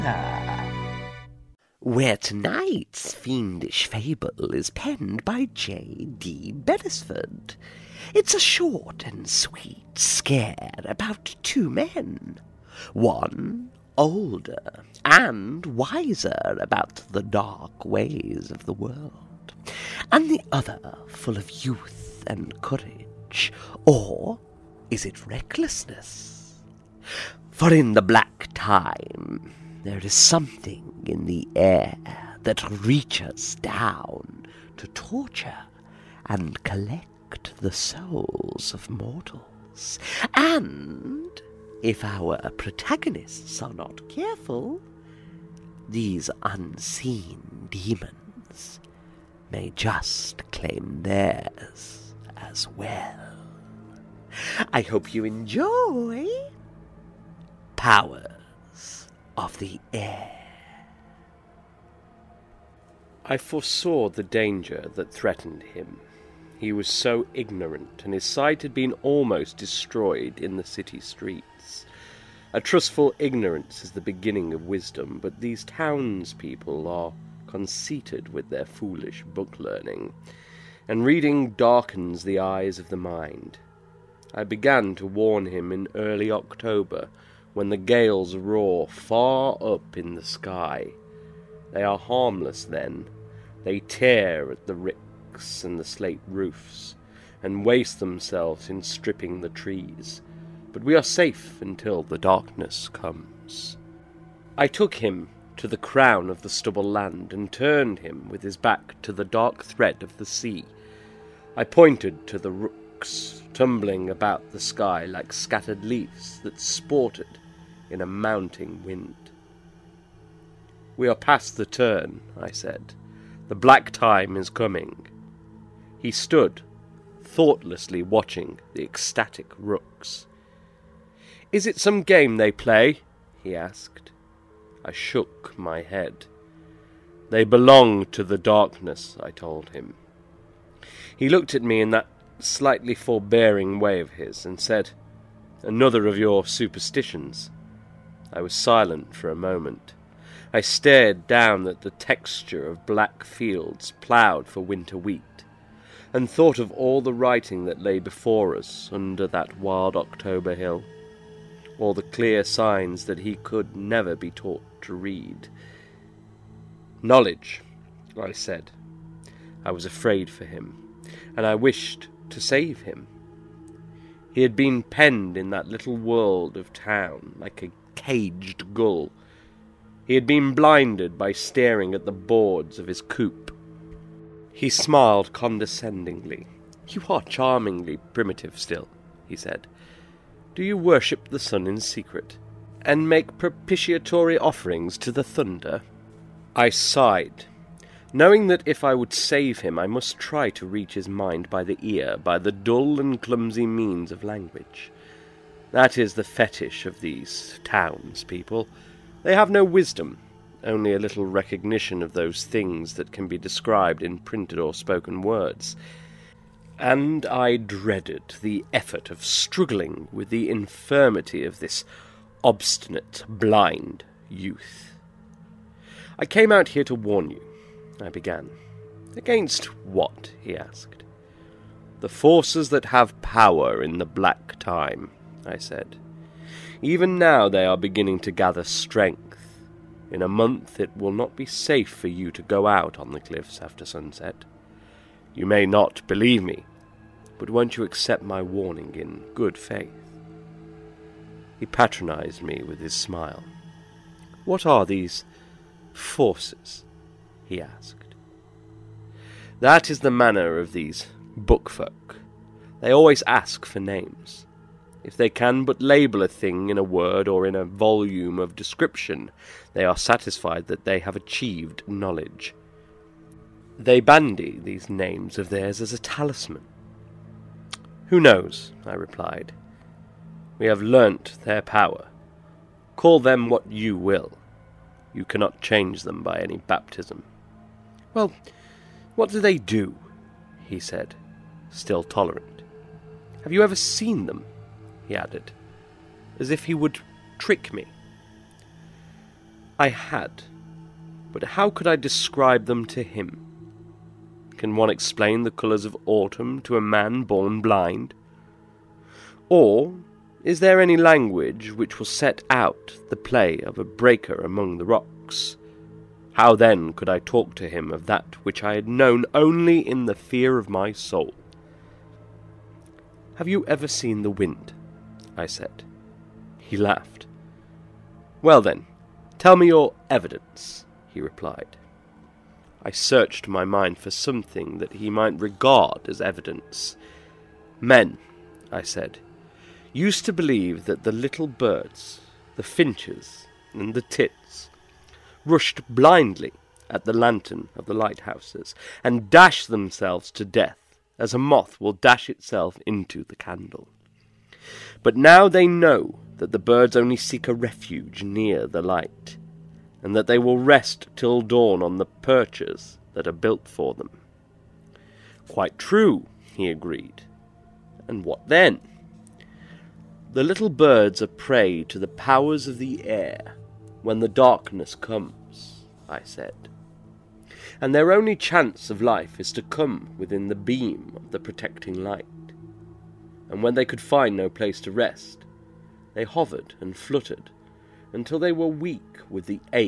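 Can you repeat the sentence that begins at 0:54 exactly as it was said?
I hope you enjoy Powers of the Air.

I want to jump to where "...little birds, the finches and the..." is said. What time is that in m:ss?
5:41.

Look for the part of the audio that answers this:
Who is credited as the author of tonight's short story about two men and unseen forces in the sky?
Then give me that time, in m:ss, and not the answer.
0:05.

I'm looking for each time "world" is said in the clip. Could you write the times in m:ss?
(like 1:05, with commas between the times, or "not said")
0:18, 2:55.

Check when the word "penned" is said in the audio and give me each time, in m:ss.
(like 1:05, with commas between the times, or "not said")
0:04, 2:54.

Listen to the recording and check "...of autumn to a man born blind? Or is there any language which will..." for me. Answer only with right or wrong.
right.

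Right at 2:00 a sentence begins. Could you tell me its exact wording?
We are past the turn, I said.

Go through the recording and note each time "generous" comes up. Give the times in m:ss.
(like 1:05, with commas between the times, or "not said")
not said.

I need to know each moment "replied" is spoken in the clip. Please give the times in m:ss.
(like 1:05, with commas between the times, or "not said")
4:38, 5:31.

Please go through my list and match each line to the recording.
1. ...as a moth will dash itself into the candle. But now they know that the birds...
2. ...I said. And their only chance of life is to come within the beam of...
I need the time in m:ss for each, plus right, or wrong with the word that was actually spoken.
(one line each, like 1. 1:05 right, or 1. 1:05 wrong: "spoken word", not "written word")
1. 5:51 right
2. 6:16 right.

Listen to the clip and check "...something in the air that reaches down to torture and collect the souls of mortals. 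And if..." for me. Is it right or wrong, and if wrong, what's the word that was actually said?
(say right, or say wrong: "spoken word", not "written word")
right.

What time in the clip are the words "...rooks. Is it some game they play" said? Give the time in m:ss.
2:09.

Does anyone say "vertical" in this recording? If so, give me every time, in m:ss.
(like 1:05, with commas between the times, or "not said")
not said.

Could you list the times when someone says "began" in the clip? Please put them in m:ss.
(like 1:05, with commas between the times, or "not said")
1:24, 3:48.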